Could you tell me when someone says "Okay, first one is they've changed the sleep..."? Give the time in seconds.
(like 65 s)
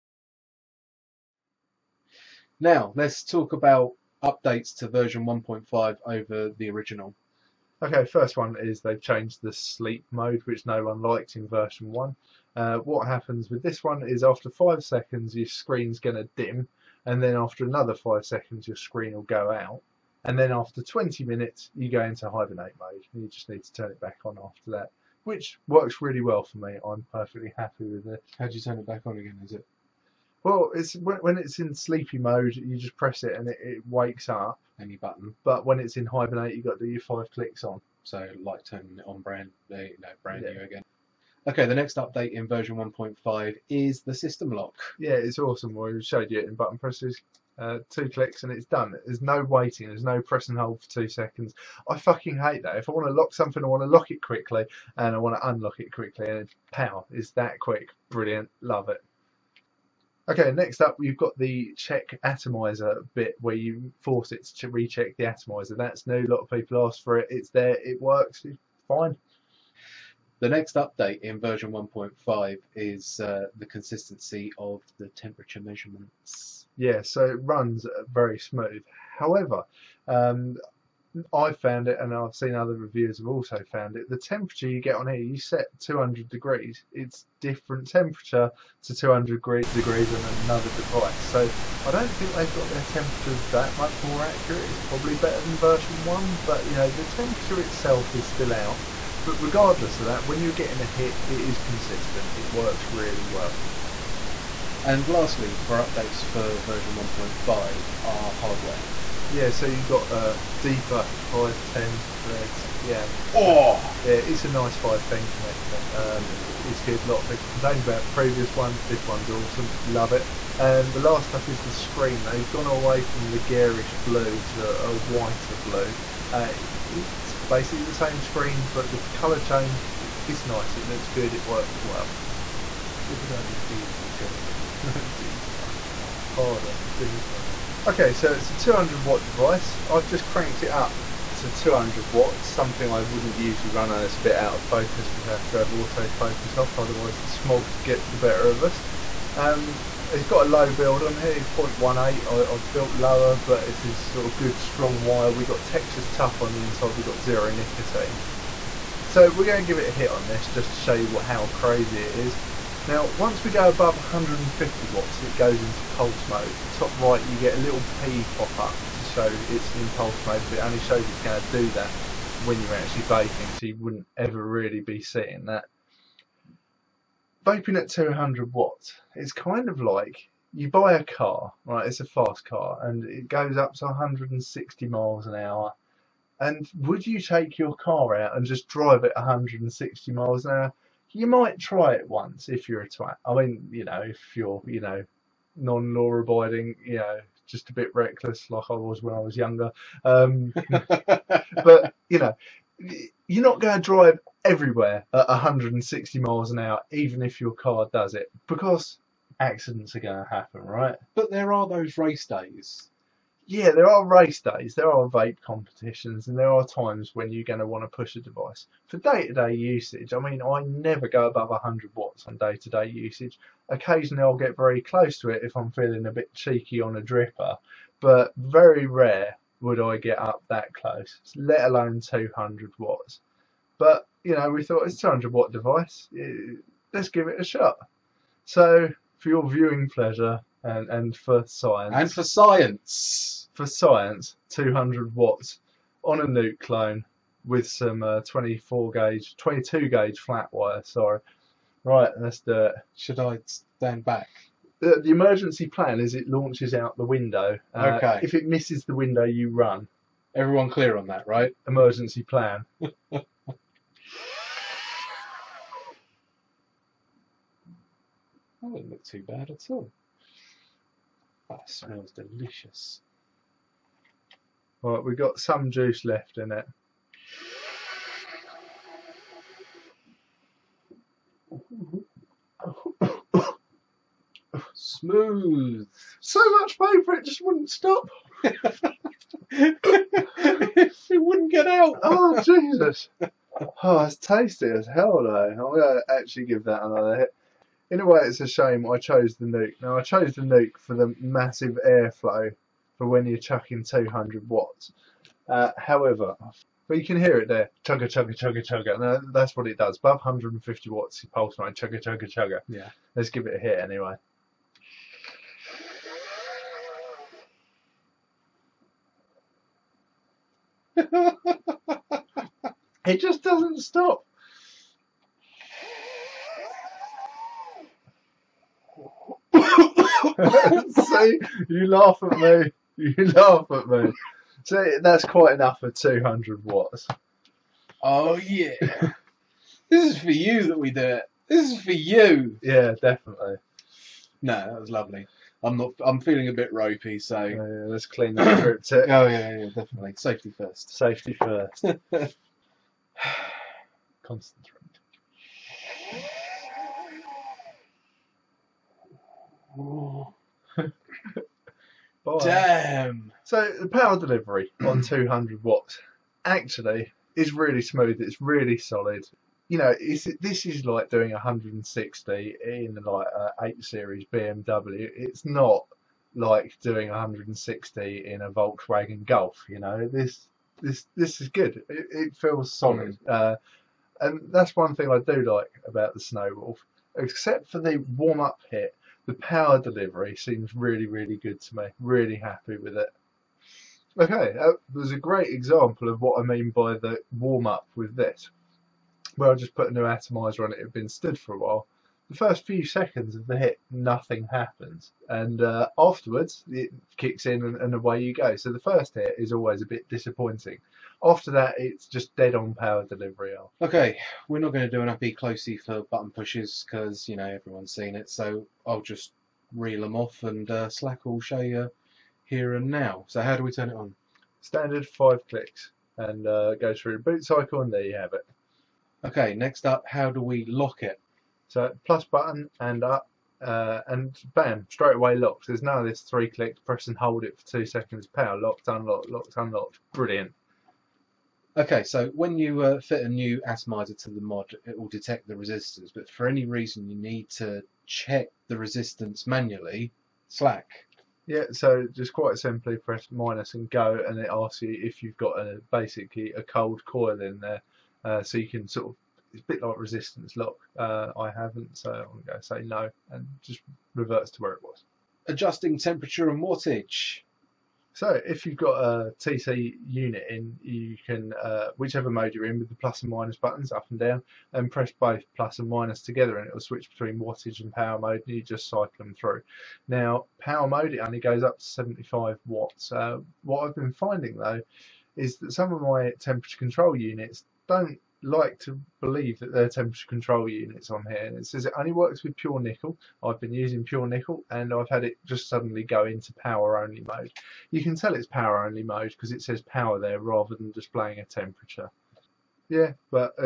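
7 s.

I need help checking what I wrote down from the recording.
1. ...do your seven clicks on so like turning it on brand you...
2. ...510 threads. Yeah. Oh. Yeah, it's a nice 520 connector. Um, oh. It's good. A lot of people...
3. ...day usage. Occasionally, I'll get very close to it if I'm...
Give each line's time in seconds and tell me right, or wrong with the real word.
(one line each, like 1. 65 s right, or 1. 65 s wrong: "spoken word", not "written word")
1. 36 s wrong: "five", not "seven"
2. 111 s wrong: "510", not "520"
3. 222 s right.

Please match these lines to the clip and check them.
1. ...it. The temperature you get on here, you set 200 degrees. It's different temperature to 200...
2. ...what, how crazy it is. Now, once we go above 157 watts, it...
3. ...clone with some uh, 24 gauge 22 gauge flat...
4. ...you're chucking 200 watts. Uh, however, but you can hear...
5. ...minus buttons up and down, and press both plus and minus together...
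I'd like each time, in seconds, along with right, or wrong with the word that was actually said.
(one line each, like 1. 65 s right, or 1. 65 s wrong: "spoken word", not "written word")
1. 83 s right
2. 161 s wrong: "150", not "157"
3. 246 s right
4. 303 s right
5. 473 s right.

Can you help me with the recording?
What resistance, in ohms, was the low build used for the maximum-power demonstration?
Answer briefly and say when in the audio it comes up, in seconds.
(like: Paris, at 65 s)
0.18, at 151 s.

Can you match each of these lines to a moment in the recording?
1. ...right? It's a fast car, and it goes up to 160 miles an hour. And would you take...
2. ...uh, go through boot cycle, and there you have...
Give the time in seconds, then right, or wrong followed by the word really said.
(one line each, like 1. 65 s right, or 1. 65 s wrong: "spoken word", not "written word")
1. 181 s right
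2. 426 s right.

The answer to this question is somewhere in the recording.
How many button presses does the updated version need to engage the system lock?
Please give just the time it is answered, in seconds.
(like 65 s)
47 s.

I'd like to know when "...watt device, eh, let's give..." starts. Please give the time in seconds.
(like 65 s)
235 s.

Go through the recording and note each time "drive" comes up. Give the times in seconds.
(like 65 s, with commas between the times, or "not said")
188 s, 203 s.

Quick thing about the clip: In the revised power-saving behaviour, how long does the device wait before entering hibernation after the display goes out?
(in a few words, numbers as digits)
20 minutes.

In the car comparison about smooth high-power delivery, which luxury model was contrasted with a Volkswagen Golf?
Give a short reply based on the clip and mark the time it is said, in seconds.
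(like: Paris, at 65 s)
8 Series BMW, at 373 s.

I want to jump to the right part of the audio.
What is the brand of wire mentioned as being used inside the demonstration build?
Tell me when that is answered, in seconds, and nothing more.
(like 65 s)
155 s.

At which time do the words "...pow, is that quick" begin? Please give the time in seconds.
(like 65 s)
56 s.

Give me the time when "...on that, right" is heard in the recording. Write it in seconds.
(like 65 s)
260 s.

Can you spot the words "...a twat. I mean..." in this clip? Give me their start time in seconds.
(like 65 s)
192 s.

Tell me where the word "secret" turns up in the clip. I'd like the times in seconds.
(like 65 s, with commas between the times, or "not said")
not said.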